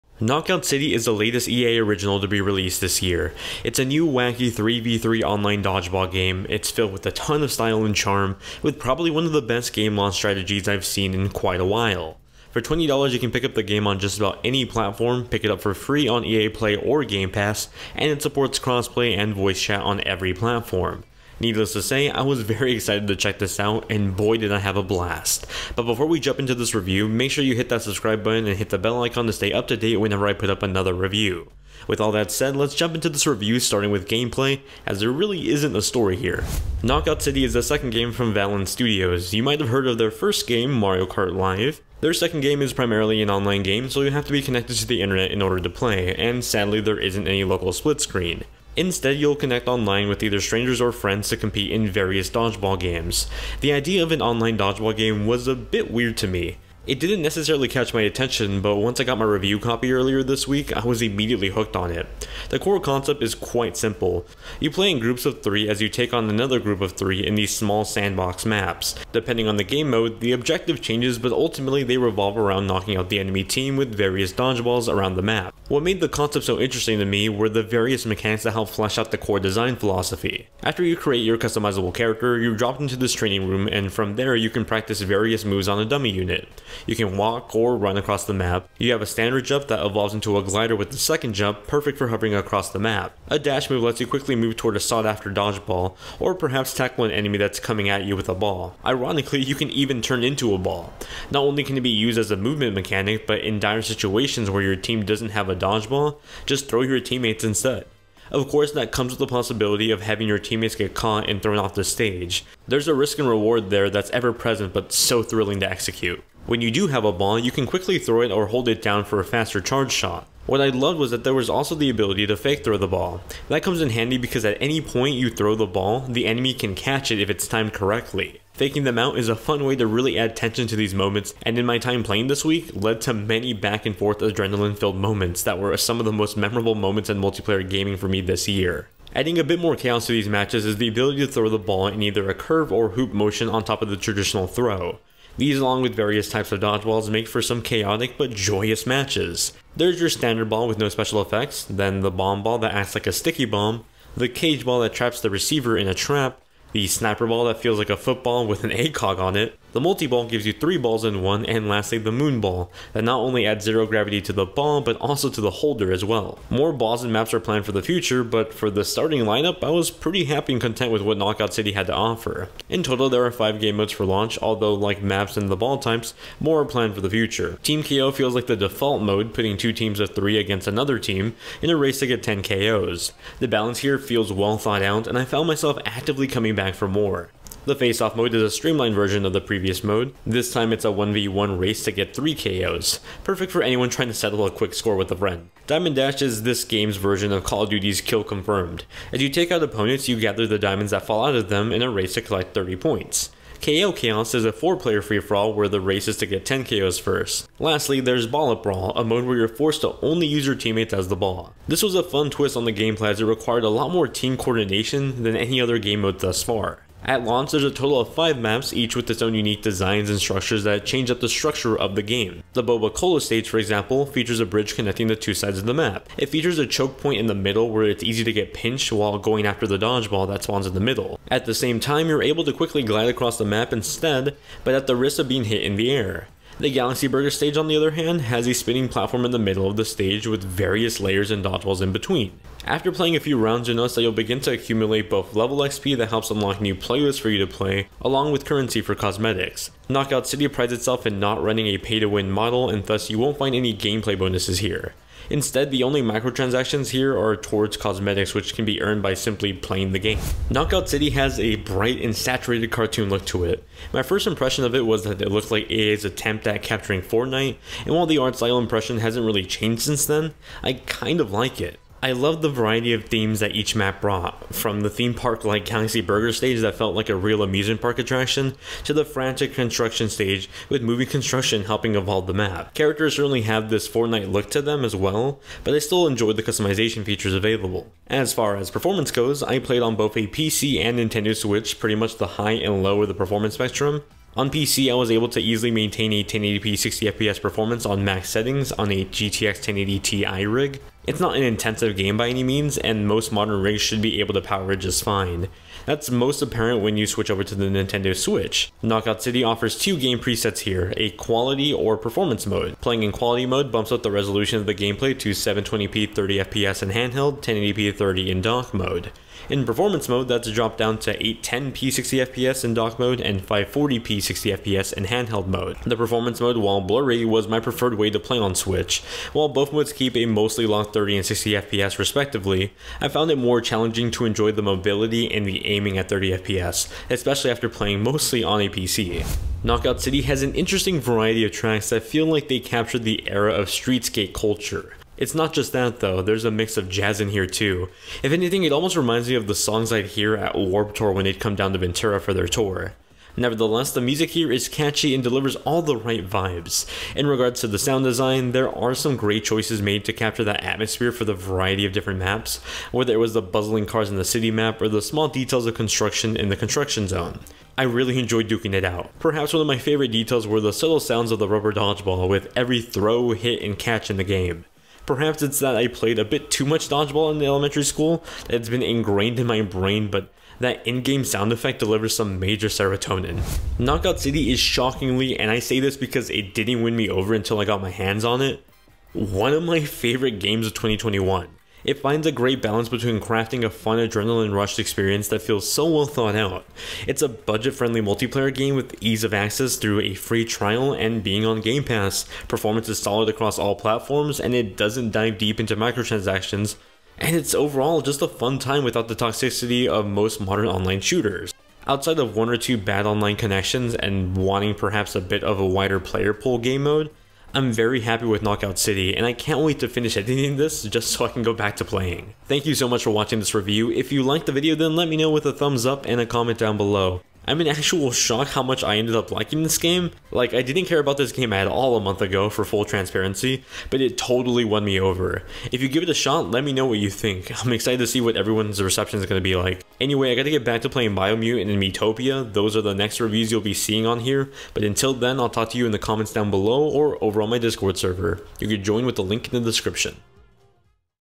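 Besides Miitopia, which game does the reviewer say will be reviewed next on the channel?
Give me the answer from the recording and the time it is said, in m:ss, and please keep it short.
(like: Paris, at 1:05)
Biomutant, at 7:21.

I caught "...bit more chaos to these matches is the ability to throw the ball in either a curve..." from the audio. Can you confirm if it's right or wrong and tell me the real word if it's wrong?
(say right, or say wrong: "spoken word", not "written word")
right.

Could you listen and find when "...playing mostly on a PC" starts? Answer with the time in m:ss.
5:37.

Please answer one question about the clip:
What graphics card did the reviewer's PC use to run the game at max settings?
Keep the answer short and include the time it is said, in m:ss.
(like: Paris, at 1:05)
GTX 1080 Ti, at 4:59.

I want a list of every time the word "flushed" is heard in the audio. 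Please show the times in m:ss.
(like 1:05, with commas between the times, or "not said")
not said.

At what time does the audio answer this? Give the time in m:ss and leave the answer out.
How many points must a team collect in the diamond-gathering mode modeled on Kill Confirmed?
3:22.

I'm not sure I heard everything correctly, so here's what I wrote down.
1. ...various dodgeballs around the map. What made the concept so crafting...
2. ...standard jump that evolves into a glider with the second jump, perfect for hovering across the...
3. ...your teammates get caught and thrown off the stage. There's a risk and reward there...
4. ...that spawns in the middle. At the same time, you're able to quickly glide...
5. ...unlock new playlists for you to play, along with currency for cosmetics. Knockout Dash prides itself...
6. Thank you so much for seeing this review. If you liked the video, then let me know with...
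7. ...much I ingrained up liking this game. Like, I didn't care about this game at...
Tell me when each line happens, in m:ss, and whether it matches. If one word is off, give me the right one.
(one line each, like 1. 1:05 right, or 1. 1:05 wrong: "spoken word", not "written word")
1. 1:13 wrong: "interesting", not "crafting"
2. 1:29 right
3. 1:50 right
4. 3:50 right
5. 4:06 wrong: "City", not "Dash"
6. 7:02 wrong: "watching", not "seeing"
7. 7:08 wrong: "ended", not "ingrained".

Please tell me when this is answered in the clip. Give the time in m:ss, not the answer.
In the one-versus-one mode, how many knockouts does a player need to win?
3:12.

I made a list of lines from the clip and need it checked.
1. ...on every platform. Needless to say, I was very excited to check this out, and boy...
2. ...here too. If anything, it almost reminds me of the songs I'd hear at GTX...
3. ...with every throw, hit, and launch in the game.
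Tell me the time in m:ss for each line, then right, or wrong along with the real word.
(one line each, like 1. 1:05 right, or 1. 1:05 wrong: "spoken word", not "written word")
1. 0:19 right
2. 5:47 wrong: "Warp", not "GTX"
3. 6:12 wrong: "catch", not "launch".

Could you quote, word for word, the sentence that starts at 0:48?
Instead, you'll connect online with either strangers or friends to compete in various dodgeball games.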